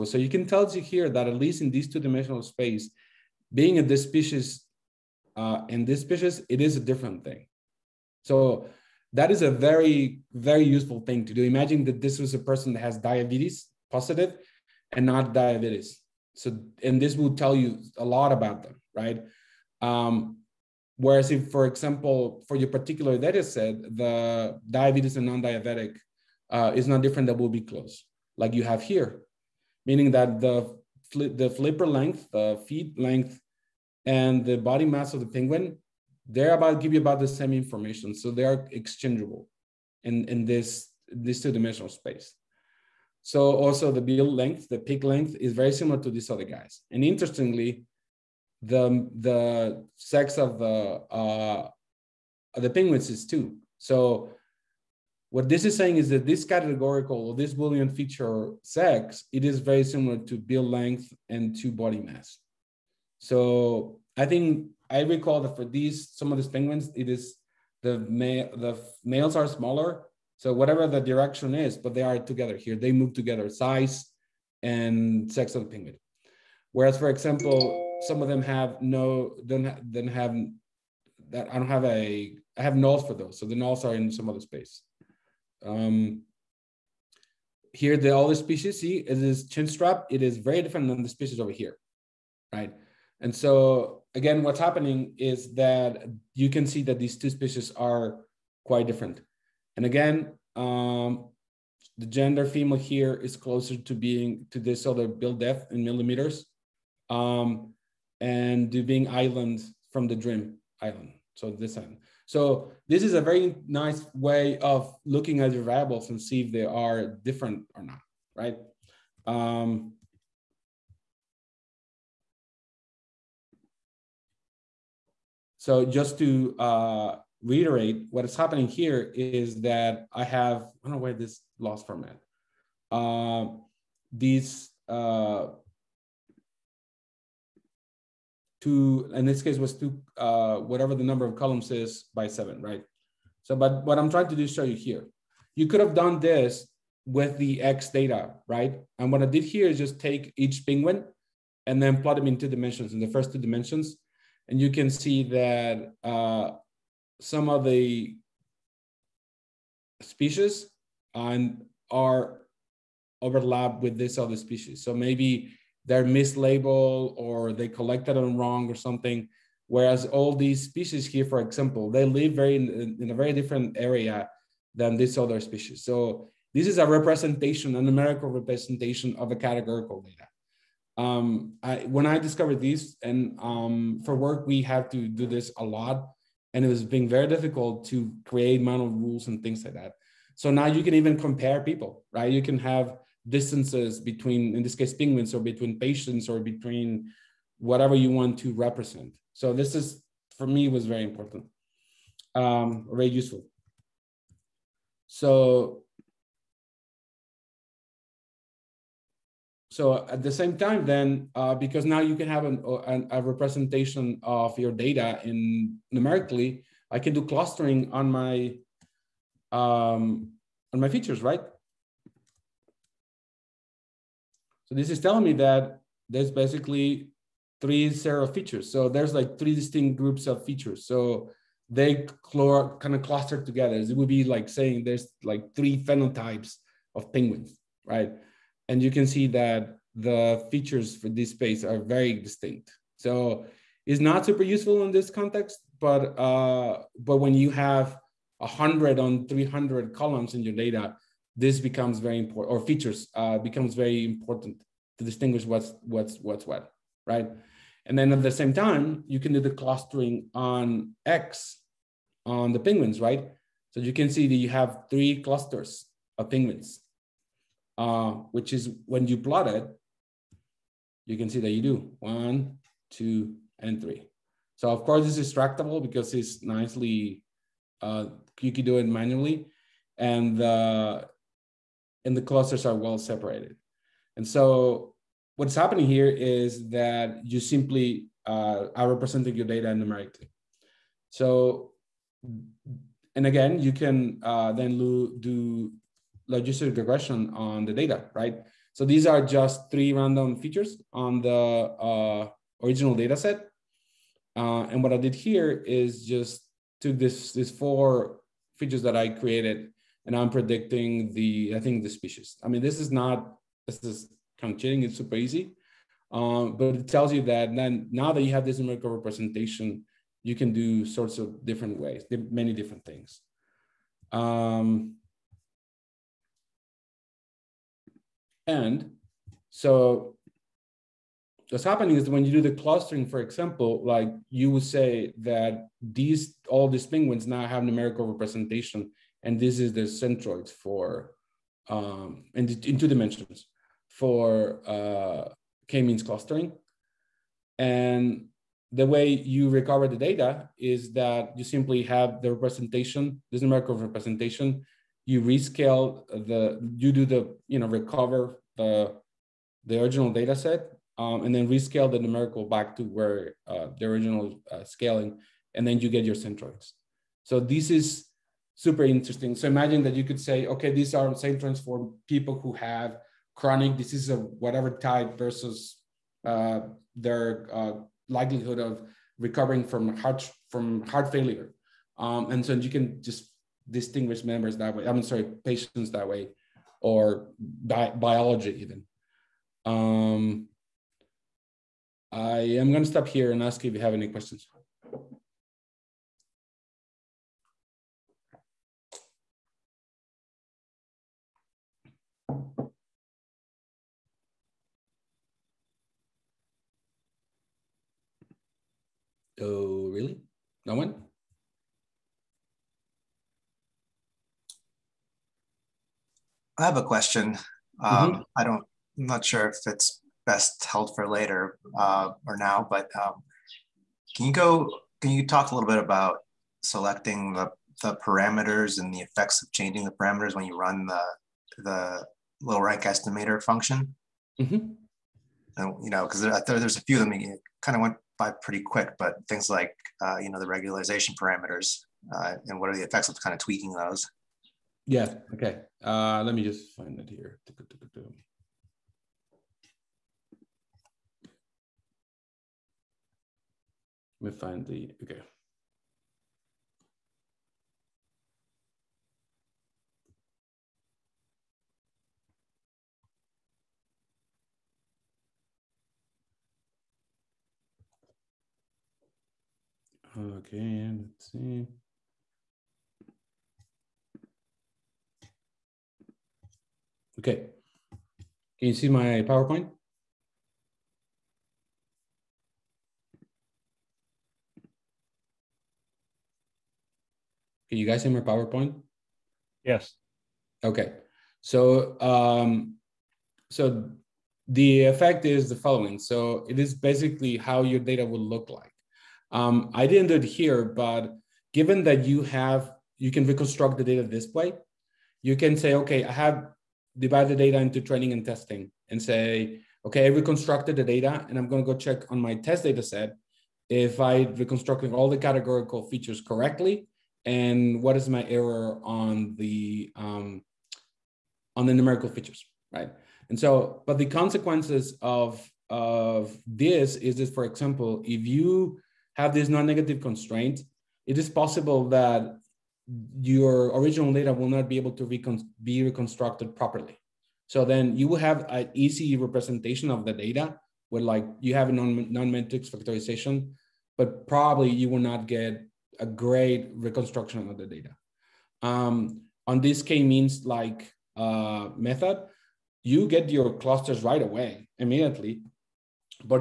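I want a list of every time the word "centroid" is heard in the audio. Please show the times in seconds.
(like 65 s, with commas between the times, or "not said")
339 s, 366 s.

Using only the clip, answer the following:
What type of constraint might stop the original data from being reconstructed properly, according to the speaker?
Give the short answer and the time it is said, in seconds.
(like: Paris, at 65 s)
non-negative, at 529 s.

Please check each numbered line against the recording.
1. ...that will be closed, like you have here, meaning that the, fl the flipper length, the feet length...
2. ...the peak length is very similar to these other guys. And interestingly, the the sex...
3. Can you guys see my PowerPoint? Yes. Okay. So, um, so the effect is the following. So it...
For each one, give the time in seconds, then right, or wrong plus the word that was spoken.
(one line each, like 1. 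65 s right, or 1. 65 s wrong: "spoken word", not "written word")
1. 27 s right
2. 44 s right
3. 487 s right.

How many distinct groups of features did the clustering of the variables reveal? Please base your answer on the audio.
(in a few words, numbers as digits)
3.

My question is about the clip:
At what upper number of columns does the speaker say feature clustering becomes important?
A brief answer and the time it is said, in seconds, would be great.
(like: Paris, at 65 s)
300, at 249 s.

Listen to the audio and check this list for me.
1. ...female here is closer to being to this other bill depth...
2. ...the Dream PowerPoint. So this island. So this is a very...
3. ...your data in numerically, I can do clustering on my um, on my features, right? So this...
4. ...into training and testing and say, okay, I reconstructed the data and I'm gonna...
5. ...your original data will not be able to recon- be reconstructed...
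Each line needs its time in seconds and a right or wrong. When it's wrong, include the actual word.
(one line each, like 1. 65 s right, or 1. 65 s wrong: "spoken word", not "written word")
1. 102 s right
2. 110 s wrong: "Island", not "PowerPoint"
3. 214 s right
4. 507 s right
5. 533 s right.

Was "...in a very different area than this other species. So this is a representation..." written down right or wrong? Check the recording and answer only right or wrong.
right.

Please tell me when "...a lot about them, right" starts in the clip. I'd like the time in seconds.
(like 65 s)
18 s.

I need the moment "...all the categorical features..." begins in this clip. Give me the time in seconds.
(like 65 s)
514 s.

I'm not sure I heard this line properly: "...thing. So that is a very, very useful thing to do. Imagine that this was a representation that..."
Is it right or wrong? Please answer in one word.
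wrong.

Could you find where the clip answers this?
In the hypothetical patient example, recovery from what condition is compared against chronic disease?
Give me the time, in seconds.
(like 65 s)
380 s.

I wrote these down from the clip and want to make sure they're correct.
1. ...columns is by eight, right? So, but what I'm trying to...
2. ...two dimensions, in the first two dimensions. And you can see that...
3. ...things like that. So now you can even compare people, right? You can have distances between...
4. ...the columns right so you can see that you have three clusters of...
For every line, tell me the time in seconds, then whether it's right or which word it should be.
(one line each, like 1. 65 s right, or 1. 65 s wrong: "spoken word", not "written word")
1. 141 s wrong: "seven", not "eight"
2. 152 s right
3. 189 s right
4. 262 s wrong: "penguins", not "columns".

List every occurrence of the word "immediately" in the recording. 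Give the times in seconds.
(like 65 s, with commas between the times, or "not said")
554 s.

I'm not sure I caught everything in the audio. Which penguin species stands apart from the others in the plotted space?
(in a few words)
chinstrap.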